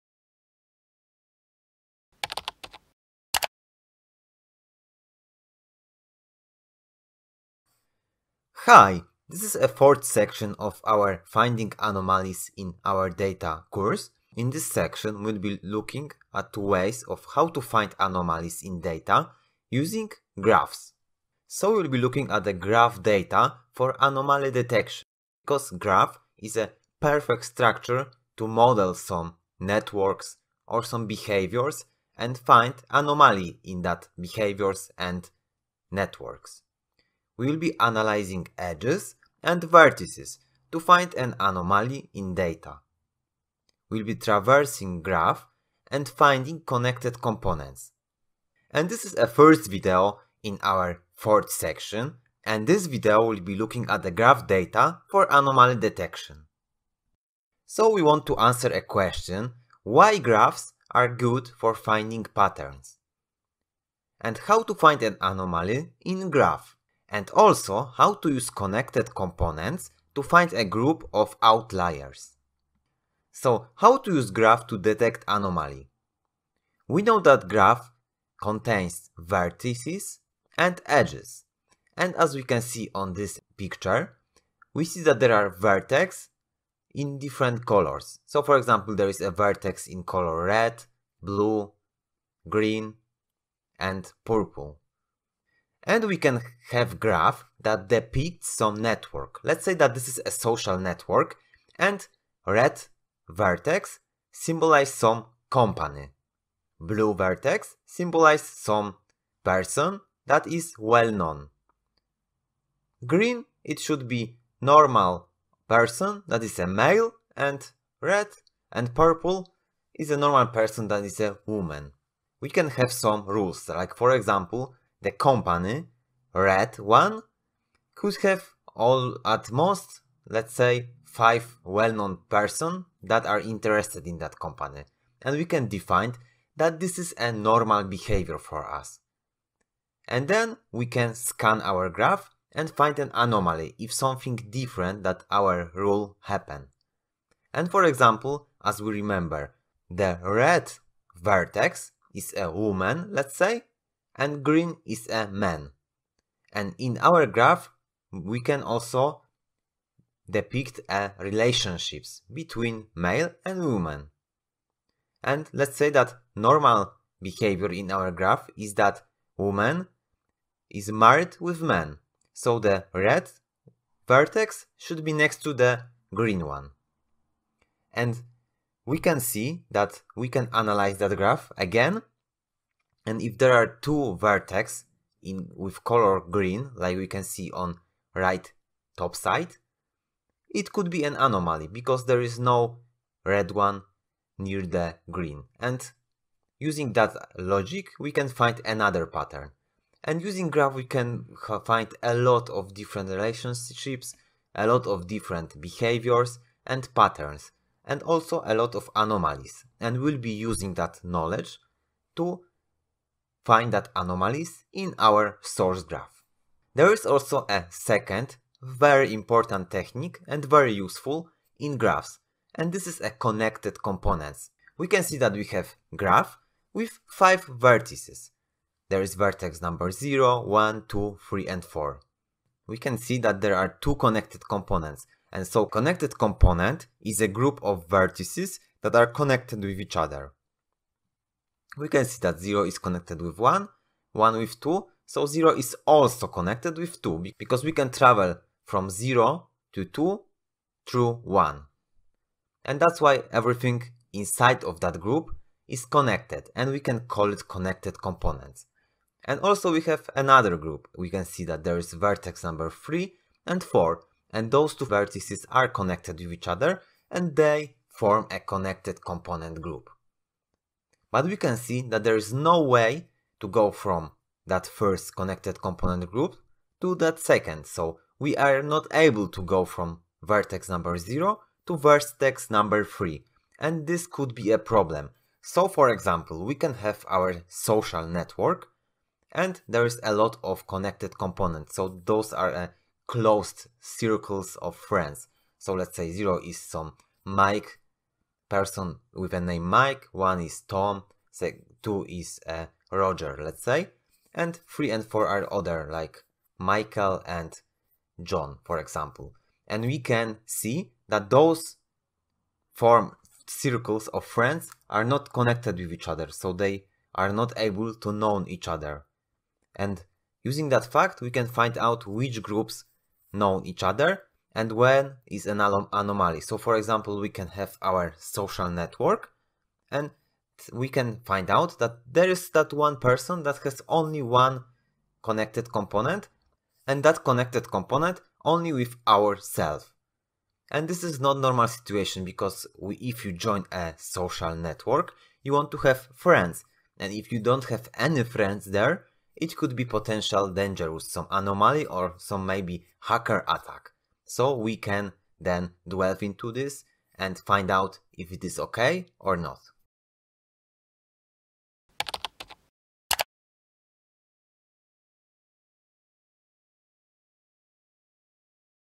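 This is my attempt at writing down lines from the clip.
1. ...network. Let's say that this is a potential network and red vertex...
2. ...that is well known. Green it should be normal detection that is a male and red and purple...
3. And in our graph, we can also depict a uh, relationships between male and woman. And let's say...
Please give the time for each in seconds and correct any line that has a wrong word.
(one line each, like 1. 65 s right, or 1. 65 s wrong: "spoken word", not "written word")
1. 98 s wrong: "social", not "potential"
2. 110 s wrong: "person", not "detection"
3. 156 s right.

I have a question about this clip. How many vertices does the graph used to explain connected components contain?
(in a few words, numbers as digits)
5.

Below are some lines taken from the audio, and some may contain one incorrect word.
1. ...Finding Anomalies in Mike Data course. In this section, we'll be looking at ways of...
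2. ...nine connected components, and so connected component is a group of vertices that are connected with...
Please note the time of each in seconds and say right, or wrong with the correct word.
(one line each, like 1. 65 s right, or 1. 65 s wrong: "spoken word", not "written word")
1. 11 s wrong: "Our", not "Mike"
2. 233 s wrong: "two", not "nine".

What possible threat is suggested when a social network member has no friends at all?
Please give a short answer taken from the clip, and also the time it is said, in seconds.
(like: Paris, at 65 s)
hacker attack, at 353 s.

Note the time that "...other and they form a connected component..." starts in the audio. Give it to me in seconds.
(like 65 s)
266 s.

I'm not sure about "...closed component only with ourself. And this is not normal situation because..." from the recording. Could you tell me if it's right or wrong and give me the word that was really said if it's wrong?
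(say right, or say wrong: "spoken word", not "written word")
wrong: "connected", not "closed".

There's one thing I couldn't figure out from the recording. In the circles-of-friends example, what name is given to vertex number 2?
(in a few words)
Roger.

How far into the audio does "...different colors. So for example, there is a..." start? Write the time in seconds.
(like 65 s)
87 s.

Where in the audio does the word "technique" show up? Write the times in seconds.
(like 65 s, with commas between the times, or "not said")
219 s.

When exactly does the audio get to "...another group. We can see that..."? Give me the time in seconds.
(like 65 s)
260 s.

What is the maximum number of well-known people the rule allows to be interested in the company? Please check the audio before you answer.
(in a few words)
5.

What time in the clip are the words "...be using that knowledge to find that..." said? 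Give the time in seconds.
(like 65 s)
210 s.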